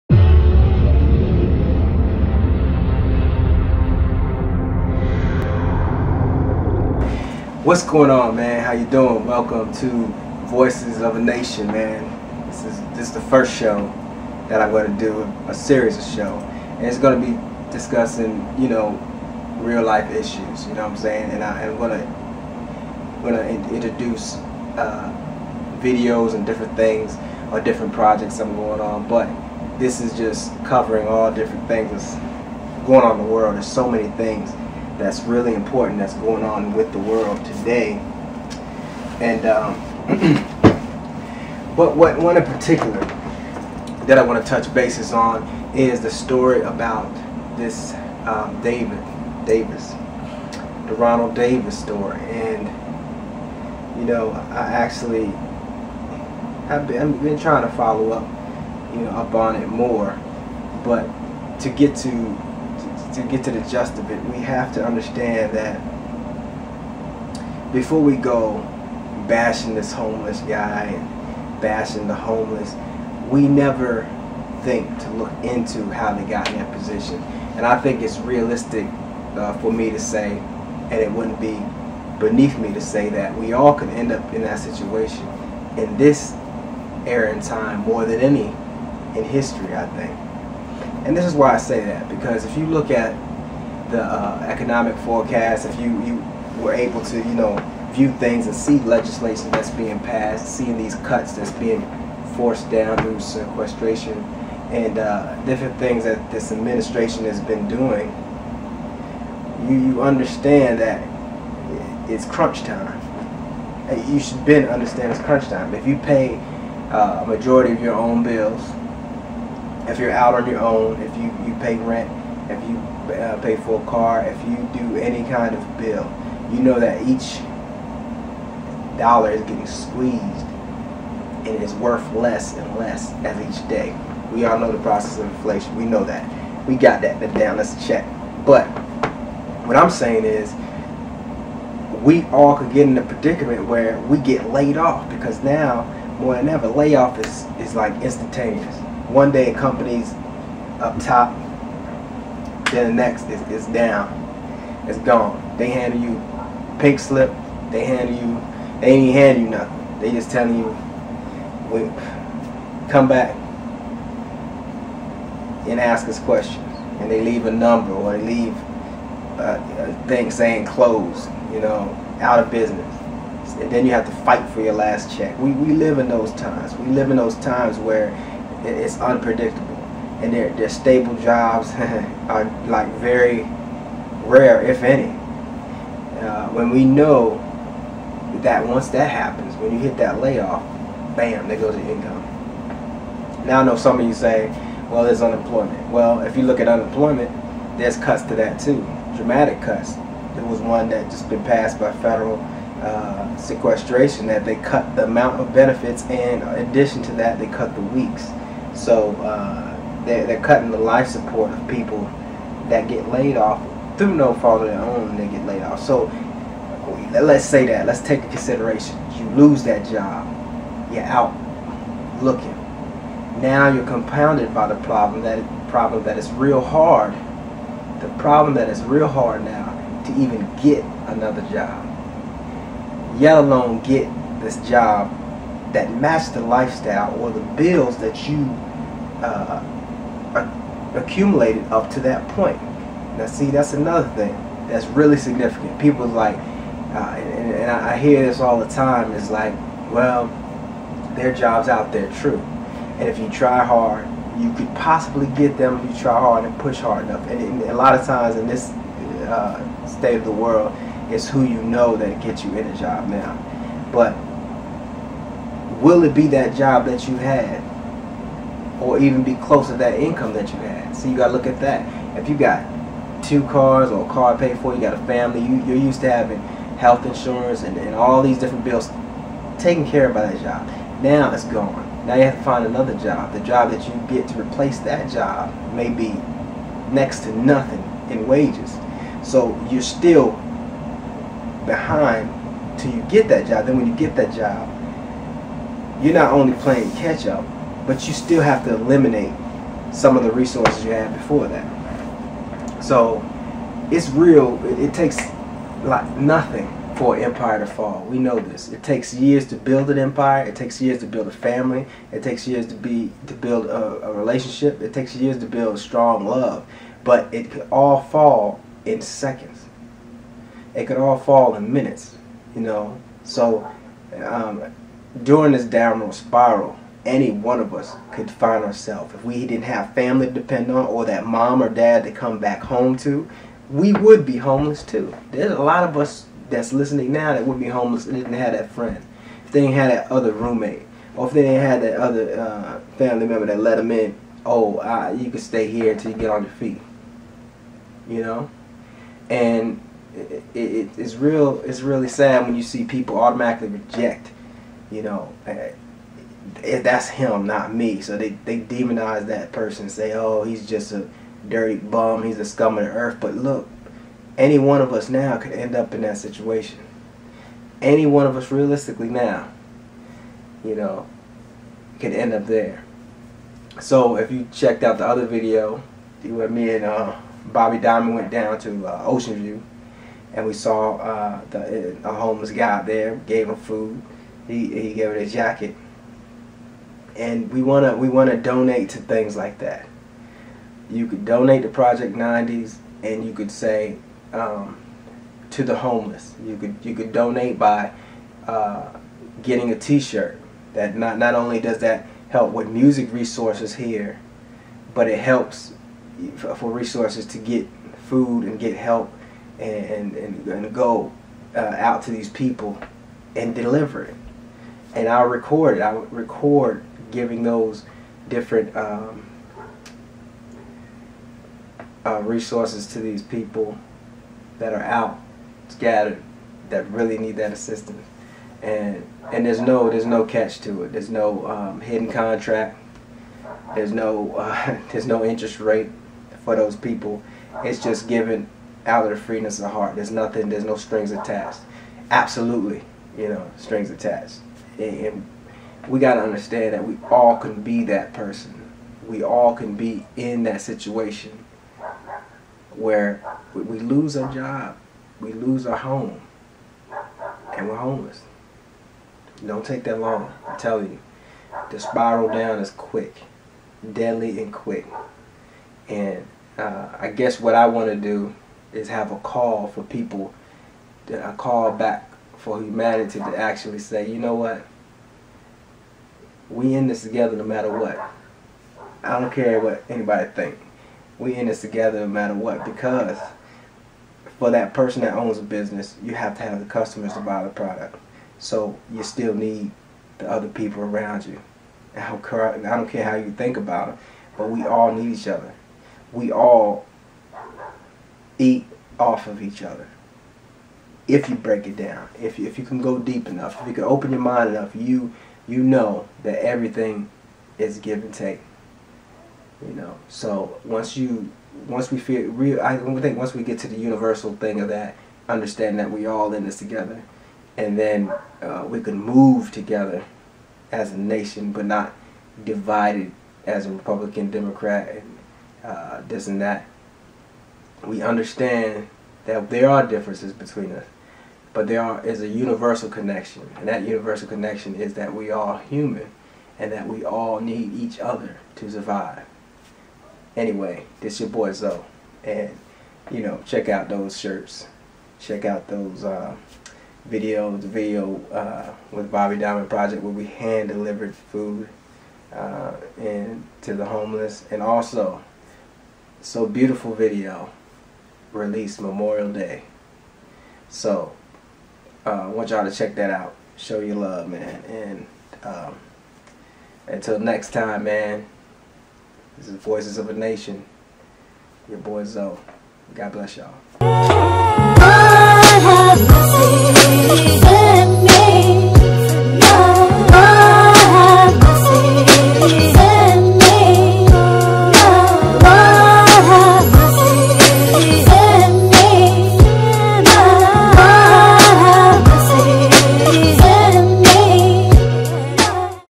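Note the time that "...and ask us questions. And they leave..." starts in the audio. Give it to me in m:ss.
2:45.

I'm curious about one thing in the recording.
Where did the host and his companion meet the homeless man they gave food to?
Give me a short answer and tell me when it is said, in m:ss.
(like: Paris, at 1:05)
Ocean View, at 6:19.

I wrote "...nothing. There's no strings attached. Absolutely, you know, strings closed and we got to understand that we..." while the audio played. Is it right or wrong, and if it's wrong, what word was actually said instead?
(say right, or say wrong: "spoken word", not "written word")
wrong: "attached", not "closed".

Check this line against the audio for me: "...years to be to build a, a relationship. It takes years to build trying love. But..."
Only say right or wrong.
wrong.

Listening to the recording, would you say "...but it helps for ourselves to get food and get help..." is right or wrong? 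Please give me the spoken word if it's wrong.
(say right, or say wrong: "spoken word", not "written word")
wrong: "resources", not "ourselves".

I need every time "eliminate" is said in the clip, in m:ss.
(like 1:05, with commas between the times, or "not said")
4:58.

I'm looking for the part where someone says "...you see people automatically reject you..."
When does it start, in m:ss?
5:52.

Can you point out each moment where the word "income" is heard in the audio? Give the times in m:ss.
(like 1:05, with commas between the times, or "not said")
3:11, 4:29.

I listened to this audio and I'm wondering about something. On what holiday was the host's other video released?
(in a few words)
Memorial Day.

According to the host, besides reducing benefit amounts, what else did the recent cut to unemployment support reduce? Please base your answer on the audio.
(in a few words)
The weeks.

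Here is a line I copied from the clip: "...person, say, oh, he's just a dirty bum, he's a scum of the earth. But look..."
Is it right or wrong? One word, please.
right.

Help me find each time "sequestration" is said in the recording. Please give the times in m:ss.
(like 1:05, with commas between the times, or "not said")
1:43, 3:23.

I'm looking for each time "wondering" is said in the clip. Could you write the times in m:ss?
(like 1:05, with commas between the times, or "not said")
not said.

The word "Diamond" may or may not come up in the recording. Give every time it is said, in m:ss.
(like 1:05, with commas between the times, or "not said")
6:17, 9:09.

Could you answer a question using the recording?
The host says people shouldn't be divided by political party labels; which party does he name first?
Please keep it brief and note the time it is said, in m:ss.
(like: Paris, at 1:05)
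Republican, at 8:43.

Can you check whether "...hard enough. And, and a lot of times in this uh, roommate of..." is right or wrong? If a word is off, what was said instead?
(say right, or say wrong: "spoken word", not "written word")
wrong: "state", not "roommate".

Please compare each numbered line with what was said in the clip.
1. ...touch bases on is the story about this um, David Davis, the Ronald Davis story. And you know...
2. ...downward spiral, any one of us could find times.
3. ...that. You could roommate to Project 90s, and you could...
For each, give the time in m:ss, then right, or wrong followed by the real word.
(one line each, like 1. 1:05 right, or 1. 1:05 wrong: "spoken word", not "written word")
1. 0:44 right
2. 5:25 wrong: "ourselves", not "times"
3. 6:29 wrong: "donate", not "roommate".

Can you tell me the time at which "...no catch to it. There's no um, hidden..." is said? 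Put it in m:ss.
7:10.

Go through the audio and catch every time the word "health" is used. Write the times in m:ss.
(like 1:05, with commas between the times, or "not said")
4:36.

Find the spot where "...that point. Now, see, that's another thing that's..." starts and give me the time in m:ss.
4:02.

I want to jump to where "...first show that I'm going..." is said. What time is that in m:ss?
0:13.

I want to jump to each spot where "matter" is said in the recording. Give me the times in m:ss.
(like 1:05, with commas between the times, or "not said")
7:57, 8:02.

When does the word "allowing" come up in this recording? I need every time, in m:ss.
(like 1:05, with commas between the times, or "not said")
not said.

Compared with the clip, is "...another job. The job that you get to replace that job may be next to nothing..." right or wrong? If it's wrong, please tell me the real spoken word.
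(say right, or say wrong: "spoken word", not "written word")
right.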